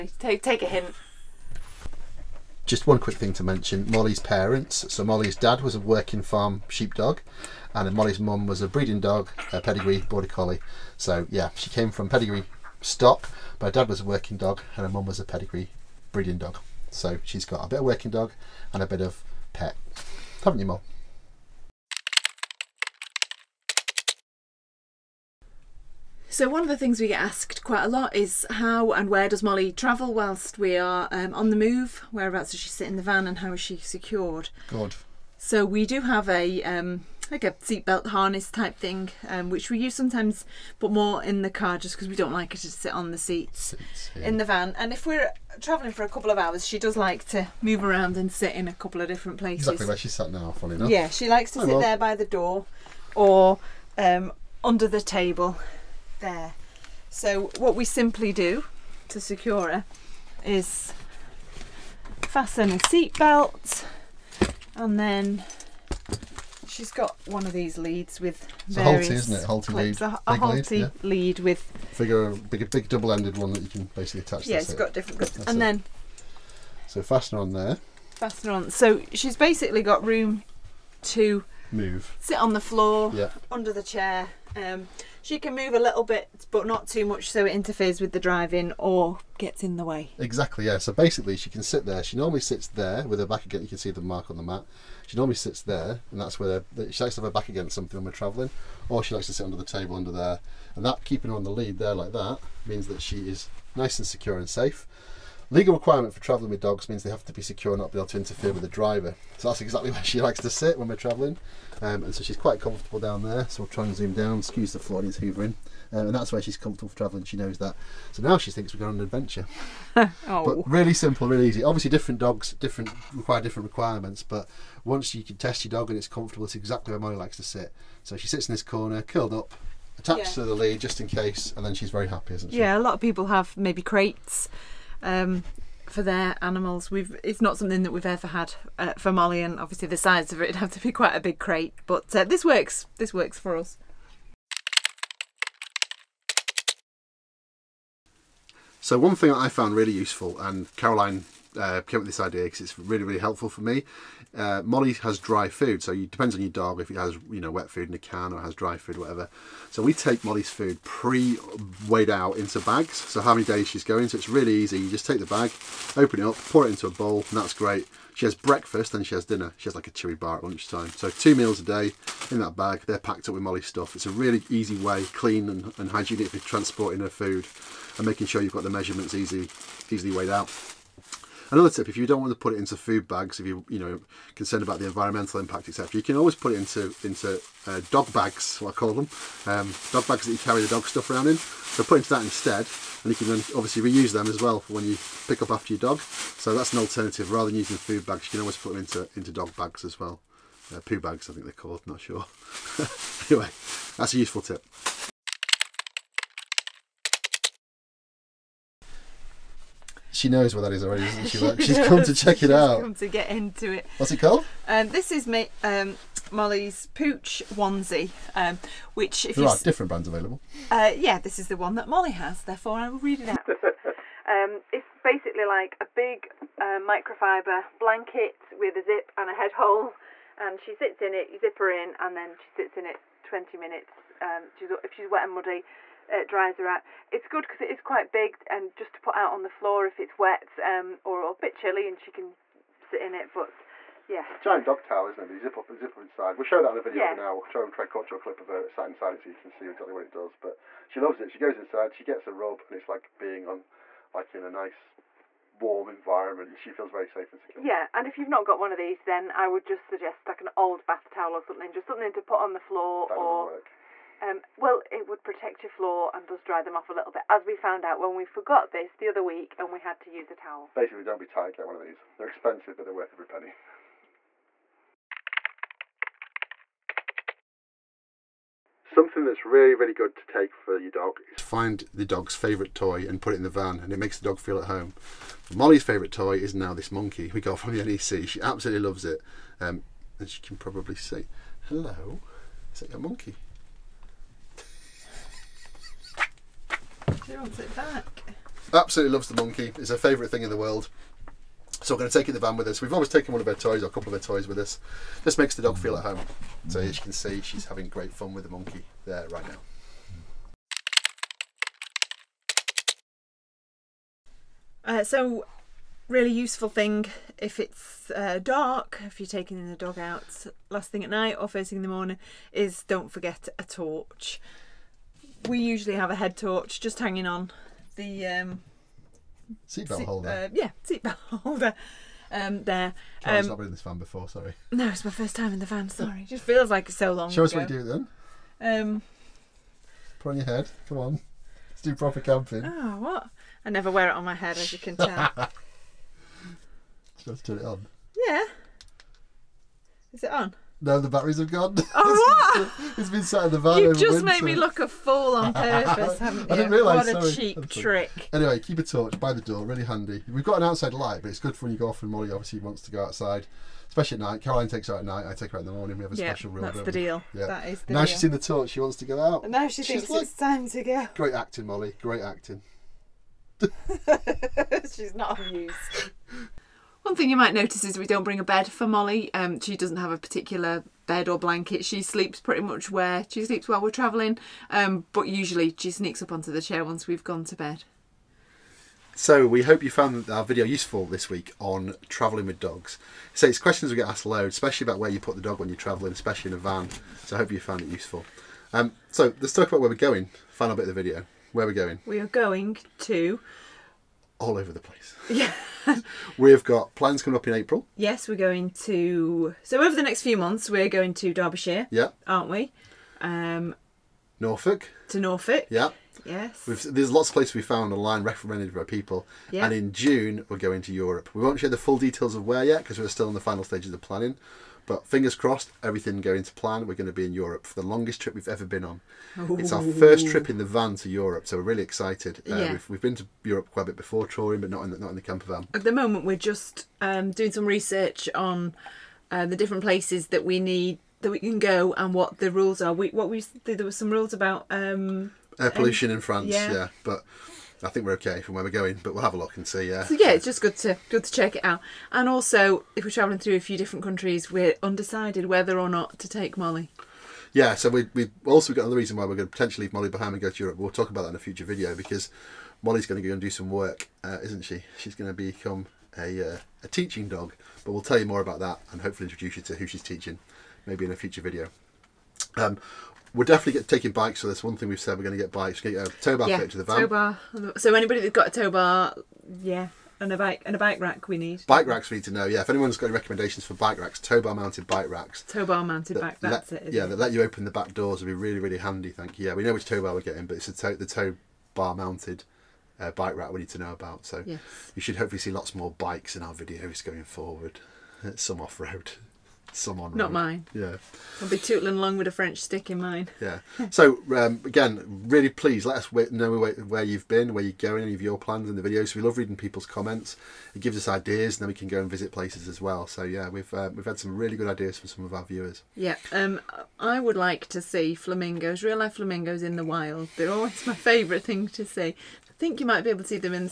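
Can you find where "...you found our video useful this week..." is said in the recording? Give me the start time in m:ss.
6:29.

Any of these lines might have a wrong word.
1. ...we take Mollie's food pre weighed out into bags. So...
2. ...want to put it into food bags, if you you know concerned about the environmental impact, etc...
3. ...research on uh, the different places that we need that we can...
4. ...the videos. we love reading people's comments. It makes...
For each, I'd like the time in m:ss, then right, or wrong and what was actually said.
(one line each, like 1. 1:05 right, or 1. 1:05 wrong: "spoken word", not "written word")
1. 2:39 right
2. 3:02 right
3. 7:17 right
4. 8:28 wrong: "gives", not "makes".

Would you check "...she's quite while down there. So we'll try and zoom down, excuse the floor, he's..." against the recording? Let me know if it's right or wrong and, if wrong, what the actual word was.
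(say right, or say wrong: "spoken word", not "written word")
wrong: "comfortable", not "while".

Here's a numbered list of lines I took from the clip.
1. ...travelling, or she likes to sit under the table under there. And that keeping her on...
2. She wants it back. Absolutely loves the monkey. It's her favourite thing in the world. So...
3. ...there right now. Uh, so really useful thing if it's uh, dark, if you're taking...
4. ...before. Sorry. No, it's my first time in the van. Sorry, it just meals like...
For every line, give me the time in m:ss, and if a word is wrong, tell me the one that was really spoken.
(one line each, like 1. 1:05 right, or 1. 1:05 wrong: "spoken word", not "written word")
1. 1:38 right
2. 4:57 right
3. 5:09 right
4. 5:33 wrong: "feels", not "meals".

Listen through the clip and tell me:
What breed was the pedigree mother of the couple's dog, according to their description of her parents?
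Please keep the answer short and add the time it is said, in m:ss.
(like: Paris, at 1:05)
Border collie, at 0:09.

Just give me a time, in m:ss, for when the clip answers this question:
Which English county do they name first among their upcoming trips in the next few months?
6:51.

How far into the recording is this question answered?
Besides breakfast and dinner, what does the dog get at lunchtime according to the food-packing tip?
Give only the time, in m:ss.
2:49.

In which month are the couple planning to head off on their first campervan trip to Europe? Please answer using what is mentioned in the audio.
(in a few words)
June.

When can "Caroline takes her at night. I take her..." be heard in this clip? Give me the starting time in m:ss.
6:04.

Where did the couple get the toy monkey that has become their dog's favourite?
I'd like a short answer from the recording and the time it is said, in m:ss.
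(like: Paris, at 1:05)
The NEC, at 4:47.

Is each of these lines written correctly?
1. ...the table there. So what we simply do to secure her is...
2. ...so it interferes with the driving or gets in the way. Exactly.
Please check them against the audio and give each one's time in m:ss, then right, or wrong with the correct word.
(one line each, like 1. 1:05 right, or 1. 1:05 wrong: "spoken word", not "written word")
1. 0:54 right
2. 1:27 right.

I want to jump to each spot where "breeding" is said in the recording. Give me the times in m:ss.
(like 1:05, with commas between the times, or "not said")
0:08, 0:16.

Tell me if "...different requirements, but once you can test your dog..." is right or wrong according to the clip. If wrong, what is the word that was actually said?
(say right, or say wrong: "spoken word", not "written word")
right.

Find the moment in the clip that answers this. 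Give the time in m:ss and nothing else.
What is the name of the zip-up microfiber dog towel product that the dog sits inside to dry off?
3:36.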